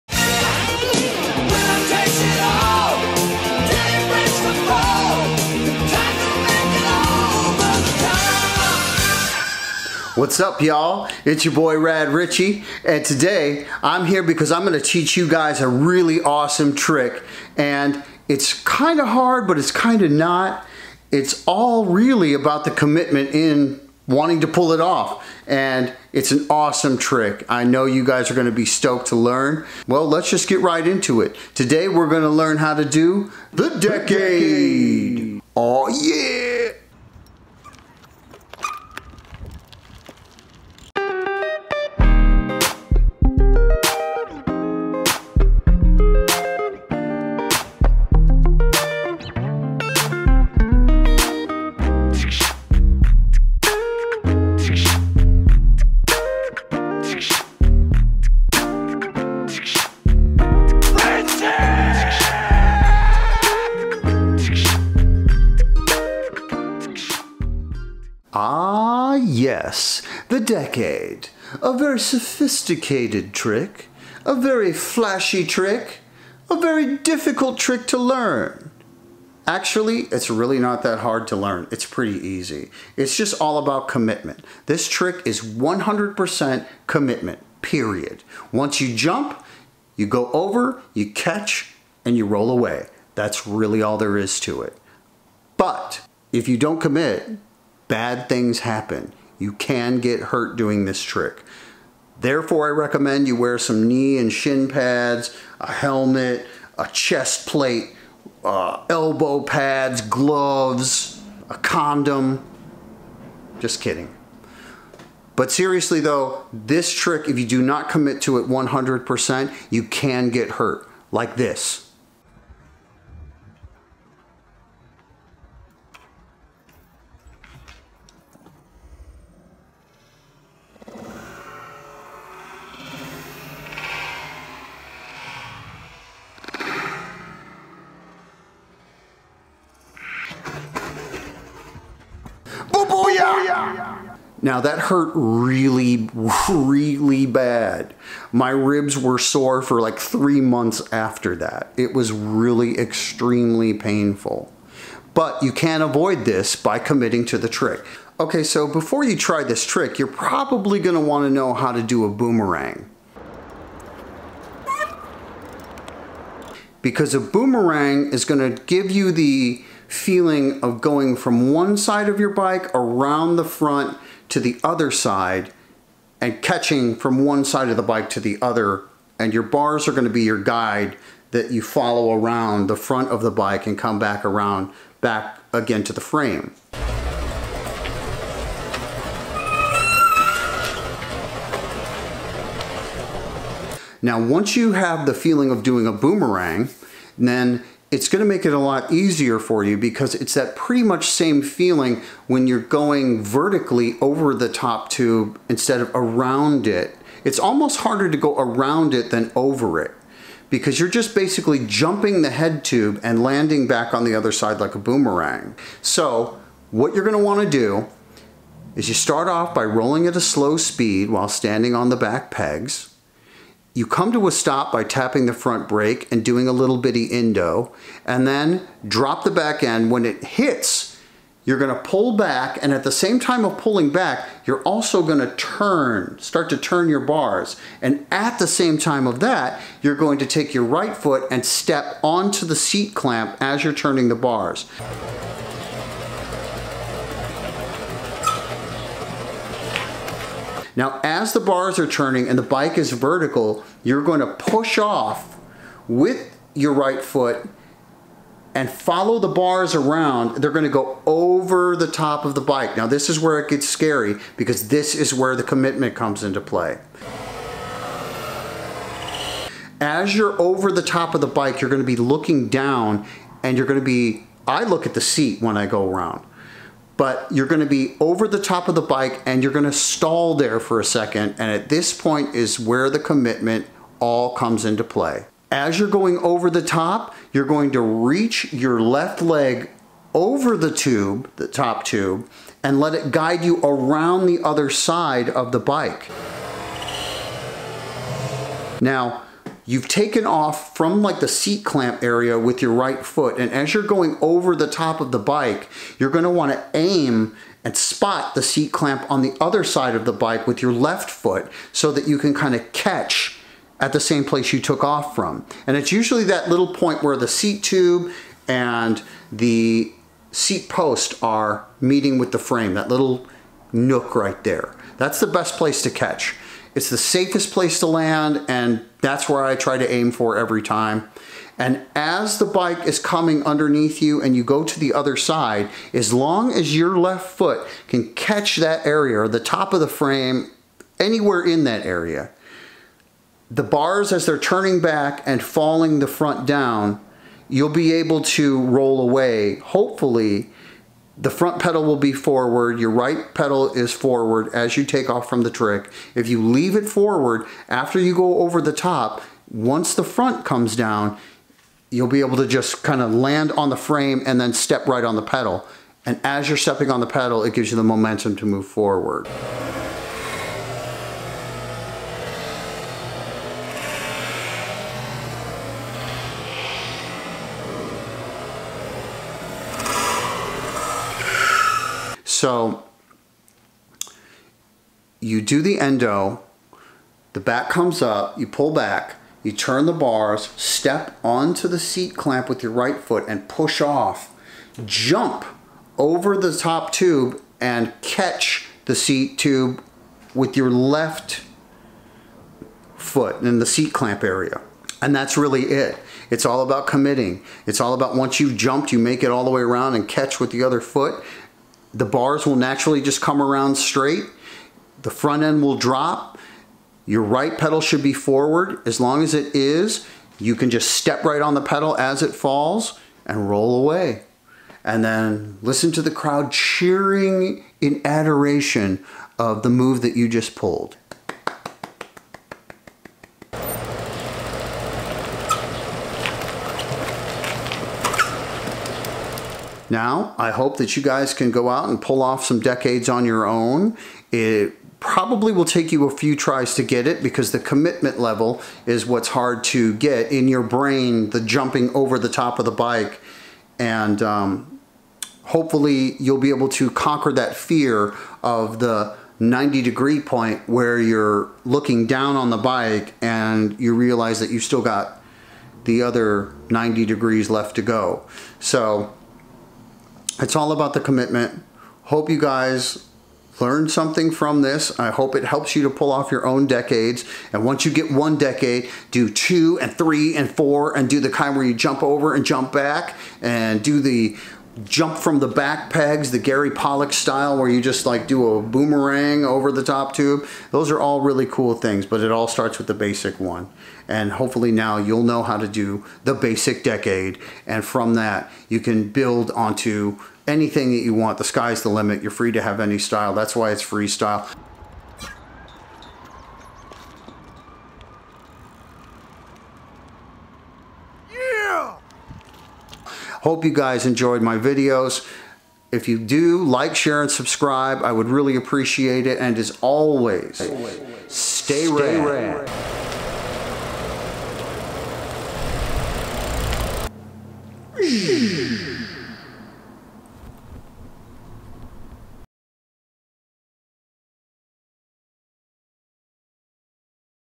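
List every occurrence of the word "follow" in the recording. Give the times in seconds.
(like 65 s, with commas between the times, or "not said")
181 s, 258 s.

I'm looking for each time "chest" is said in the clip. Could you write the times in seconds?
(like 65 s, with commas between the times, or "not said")
106 s.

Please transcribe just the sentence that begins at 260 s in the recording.
They're going to go over the top of the bike.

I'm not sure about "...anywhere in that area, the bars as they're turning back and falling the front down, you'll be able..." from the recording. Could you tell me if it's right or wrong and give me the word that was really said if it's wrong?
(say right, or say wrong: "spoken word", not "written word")
right.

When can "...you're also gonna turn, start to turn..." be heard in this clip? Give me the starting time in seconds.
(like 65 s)
234 s.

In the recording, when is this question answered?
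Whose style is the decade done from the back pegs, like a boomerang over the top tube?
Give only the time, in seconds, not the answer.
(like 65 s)
486 s.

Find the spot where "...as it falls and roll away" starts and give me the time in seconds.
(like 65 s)
421 s.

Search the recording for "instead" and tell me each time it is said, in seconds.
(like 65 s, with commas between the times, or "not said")
205 s.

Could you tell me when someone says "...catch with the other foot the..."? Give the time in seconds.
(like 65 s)
410 s.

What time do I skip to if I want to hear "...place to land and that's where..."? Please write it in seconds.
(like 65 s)
327 s.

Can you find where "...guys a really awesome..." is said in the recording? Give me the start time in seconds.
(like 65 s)
15 s.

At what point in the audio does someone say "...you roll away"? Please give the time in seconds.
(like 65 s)
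92 s.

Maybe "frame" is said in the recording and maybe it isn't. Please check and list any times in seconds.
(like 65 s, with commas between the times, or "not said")
186 s, 322 s, 339 s, 363 s.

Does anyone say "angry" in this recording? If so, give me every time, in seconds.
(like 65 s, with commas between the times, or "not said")
not said.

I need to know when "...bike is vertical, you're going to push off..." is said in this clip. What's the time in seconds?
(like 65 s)
252 s.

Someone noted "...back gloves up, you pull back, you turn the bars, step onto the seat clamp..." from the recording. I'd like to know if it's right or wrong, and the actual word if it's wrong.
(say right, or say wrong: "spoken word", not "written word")
wrong: "comes", not "gloves".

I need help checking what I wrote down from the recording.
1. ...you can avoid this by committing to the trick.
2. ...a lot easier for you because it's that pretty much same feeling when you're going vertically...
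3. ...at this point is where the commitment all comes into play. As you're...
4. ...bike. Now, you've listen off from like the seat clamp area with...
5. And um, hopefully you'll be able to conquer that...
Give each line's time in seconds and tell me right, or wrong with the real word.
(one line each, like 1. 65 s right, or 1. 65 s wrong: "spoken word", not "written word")
1. 155 s right
2. 198 s right
3. 281 s right
4. 295 s wrong: "taken", not "listen"
5. 453 s right.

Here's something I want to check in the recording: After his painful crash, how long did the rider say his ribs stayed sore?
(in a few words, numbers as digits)
3 months.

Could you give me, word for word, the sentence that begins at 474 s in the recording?
I hope it helps you to pull off your own decades.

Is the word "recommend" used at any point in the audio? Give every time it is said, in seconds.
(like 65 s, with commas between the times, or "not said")
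102 s.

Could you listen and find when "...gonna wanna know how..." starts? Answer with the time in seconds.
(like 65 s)
160 s.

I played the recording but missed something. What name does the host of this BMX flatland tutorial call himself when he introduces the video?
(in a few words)
Rad Richie.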